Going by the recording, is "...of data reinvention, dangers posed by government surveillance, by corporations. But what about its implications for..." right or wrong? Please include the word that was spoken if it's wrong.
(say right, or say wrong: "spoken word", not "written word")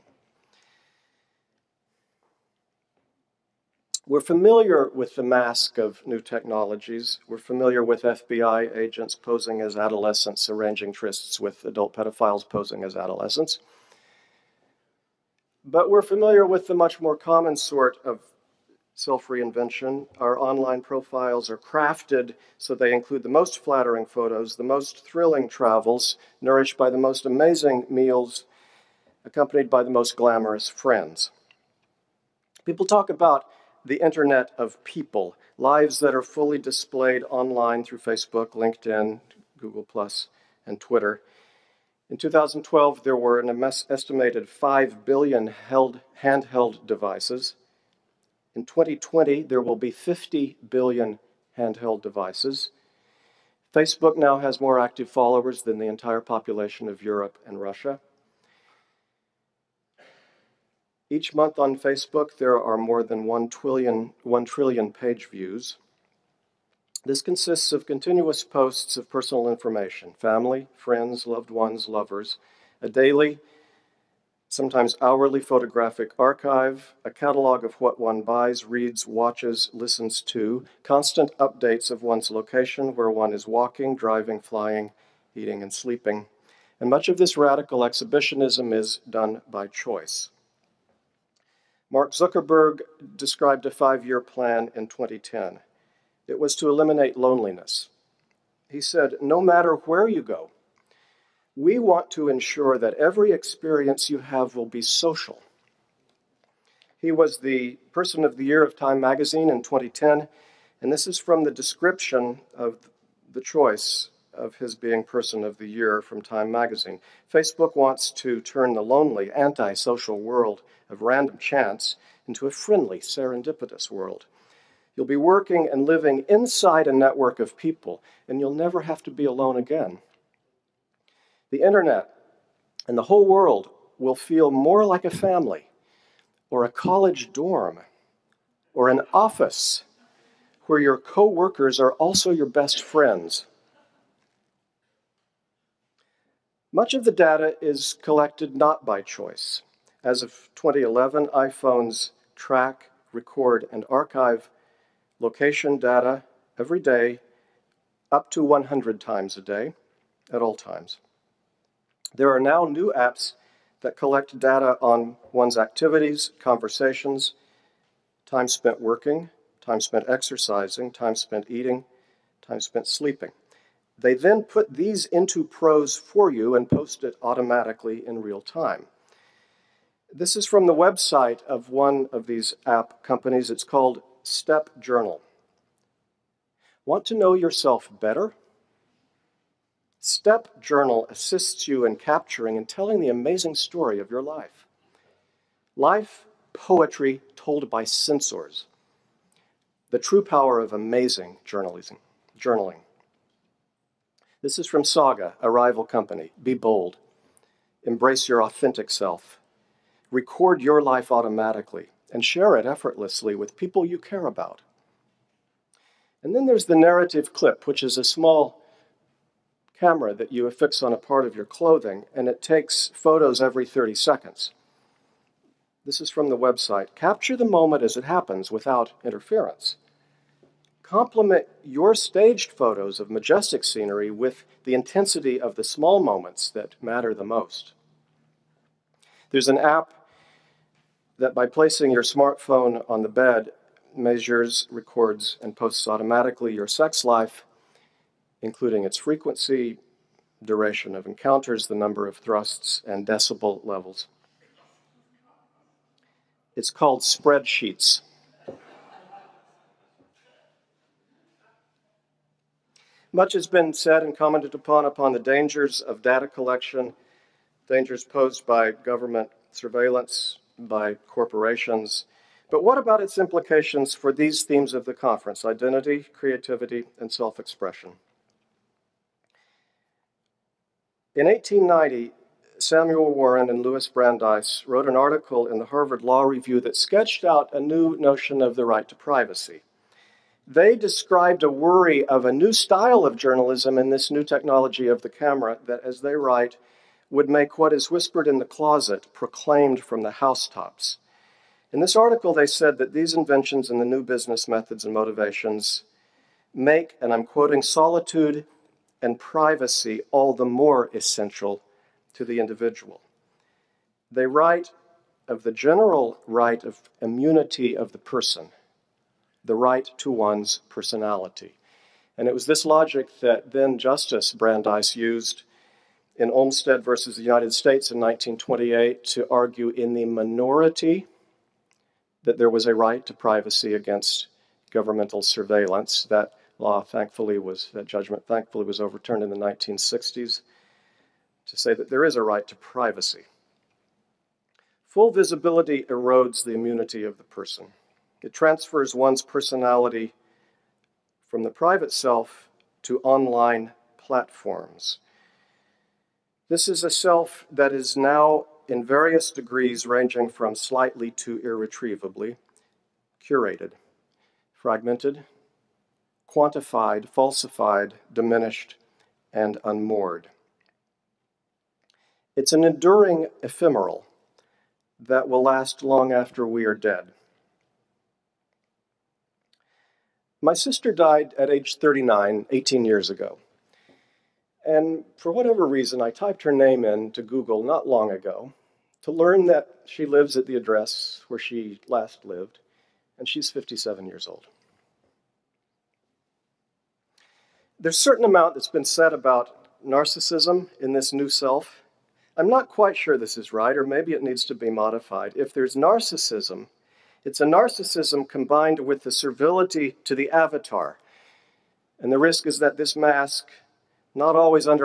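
wrong: "collection", not "reinvention".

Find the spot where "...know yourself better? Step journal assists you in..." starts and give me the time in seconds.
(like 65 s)
187 s.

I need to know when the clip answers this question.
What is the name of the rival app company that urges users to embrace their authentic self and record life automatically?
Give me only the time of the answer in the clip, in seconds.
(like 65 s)
204 s.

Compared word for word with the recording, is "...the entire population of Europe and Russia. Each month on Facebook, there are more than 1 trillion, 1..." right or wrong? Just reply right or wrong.
right.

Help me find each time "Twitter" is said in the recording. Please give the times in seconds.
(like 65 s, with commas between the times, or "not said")
40 s.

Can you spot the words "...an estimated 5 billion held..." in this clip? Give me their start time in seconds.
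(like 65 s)
43 s.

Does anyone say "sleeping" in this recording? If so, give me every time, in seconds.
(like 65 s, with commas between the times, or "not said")
85 s, 172 s.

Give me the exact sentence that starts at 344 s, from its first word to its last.
Full visibility erodes the immunity of the person.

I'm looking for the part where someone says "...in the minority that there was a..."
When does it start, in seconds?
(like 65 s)
329 s.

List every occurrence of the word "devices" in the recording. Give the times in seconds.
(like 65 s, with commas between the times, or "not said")
46 s, 52 s.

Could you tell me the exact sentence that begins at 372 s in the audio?
It's an enduring ephemeral that will last long after we are dead.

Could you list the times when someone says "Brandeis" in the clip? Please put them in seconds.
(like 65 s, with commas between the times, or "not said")
283 s, 324 s.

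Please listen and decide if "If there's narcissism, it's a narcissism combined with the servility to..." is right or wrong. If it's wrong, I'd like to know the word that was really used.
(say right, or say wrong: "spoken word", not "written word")
right.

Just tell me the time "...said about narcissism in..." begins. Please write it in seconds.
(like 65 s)
398 s.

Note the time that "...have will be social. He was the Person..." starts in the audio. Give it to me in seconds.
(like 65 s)
104 s.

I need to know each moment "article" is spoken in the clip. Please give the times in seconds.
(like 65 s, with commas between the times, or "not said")
284 s, 301 s.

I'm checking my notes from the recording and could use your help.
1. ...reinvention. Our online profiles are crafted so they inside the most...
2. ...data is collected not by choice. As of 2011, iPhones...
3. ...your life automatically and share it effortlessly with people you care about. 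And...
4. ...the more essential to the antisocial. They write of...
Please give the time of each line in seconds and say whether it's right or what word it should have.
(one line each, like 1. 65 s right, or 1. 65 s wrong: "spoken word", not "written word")
1. 19 s wrong: "include", not "inside"
2. 147 s right
3. 210 s right
4. 310 s wrong: "individual", not "antisocial".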